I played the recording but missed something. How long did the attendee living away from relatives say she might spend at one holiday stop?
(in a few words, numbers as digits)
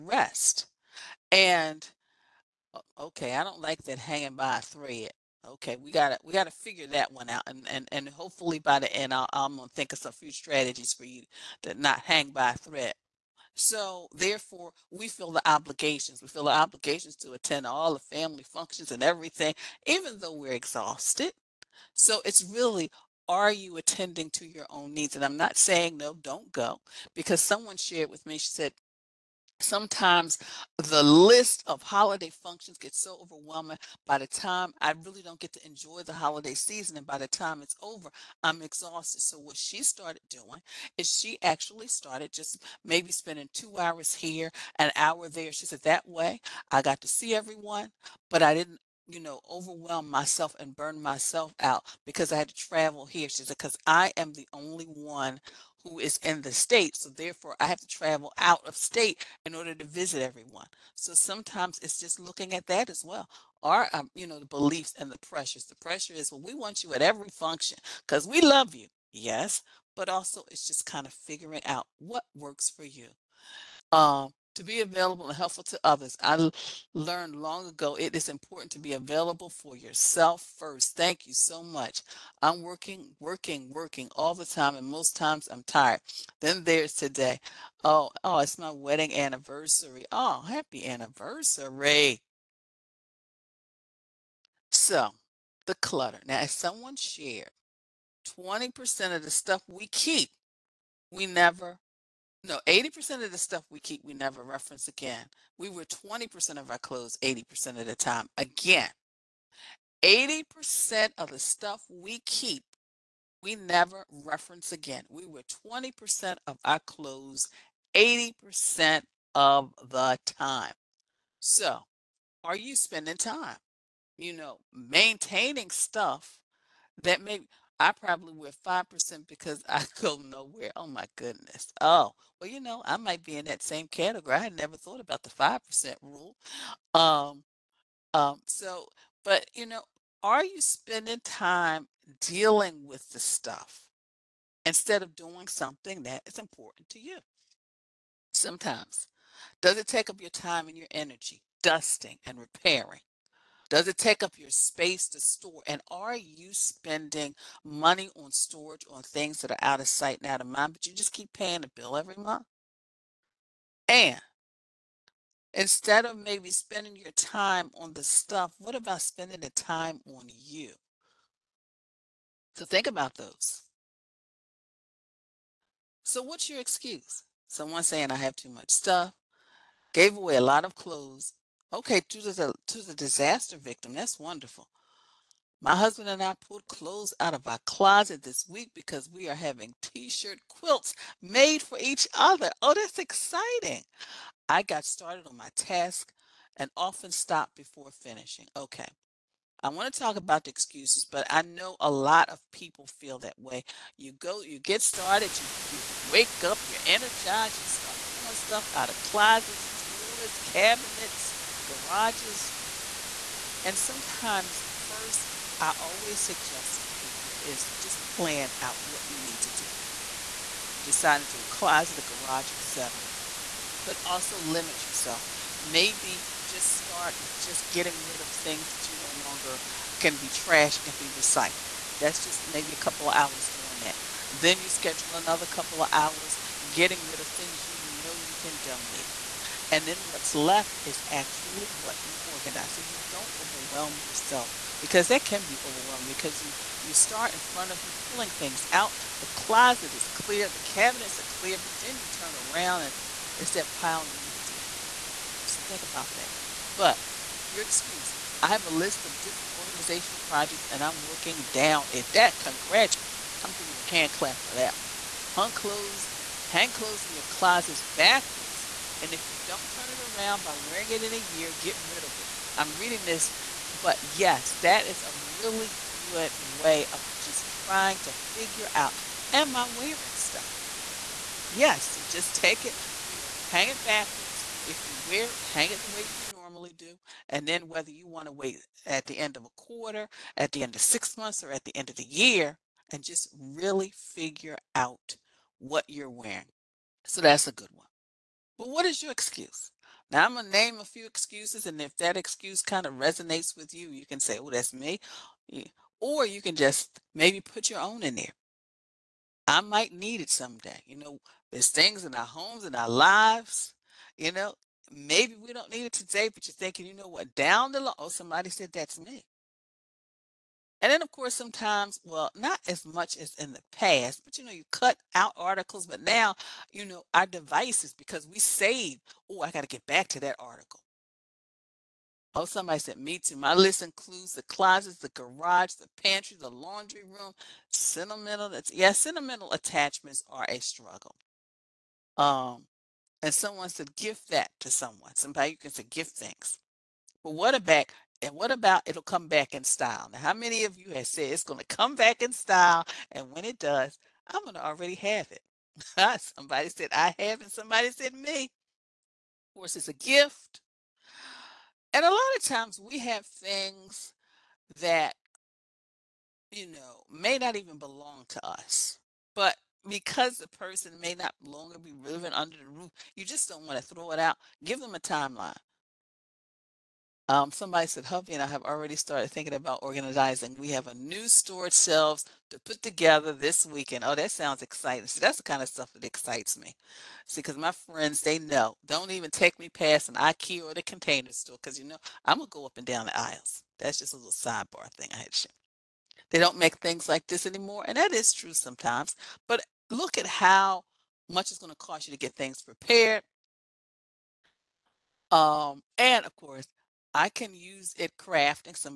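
2 hours.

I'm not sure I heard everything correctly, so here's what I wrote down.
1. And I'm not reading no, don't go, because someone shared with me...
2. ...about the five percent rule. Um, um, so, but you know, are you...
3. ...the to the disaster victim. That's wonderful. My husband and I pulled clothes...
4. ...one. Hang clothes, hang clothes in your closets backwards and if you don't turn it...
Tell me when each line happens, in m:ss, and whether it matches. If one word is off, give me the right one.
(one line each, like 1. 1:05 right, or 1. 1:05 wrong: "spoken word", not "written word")
1. 0:25 wrong: "saying", not "reading"
2. 2:14 right
3. 3:02 right
4. 4:24 right.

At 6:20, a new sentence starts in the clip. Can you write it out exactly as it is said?
We have a new storage shelves to put together this weekend.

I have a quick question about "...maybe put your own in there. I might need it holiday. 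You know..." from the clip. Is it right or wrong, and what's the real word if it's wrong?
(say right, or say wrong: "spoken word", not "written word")
wrong: "someday", not "holiday".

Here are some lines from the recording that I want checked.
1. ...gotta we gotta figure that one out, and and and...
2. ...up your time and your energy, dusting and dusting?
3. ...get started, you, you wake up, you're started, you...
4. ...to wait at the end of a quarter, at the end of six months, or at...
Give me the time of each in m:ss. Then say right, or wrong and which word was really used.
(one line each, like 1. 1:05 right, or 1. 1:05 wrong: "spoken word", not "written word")
1. 0:05 right
2. 2:30 wrong: "repairing", not "dusting"
3. 3:24 wrong: "energized", not "started"
4. 4:48 right.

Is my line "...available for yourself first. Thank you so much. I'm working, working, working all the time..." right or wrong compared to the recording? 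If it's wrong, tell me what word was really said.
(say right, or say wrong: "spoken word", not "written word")
right.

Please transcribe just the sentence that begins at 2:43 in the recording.
And instead of maybe spending your time on the stuff, what about spending the time on you?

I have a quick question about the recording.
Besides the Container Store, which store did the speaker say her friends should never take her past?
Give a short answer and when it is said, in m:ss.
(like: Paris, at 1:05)
IKEA, at 6:30.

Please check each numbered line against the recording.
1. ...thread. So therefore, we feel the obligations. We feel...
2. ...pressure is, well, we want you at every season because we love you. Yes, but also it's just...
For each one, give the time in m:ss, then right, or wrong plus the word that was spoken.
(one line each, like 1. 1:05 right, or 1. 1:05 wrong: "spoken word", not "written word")
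1. 0:12 right
2. 1:05 wrong: "function", not "season".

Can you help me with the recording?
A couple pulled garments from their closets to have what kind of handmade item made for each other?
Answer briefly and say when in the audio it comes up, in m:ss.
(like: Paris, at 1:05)
t-shirt quilts, at 3:09.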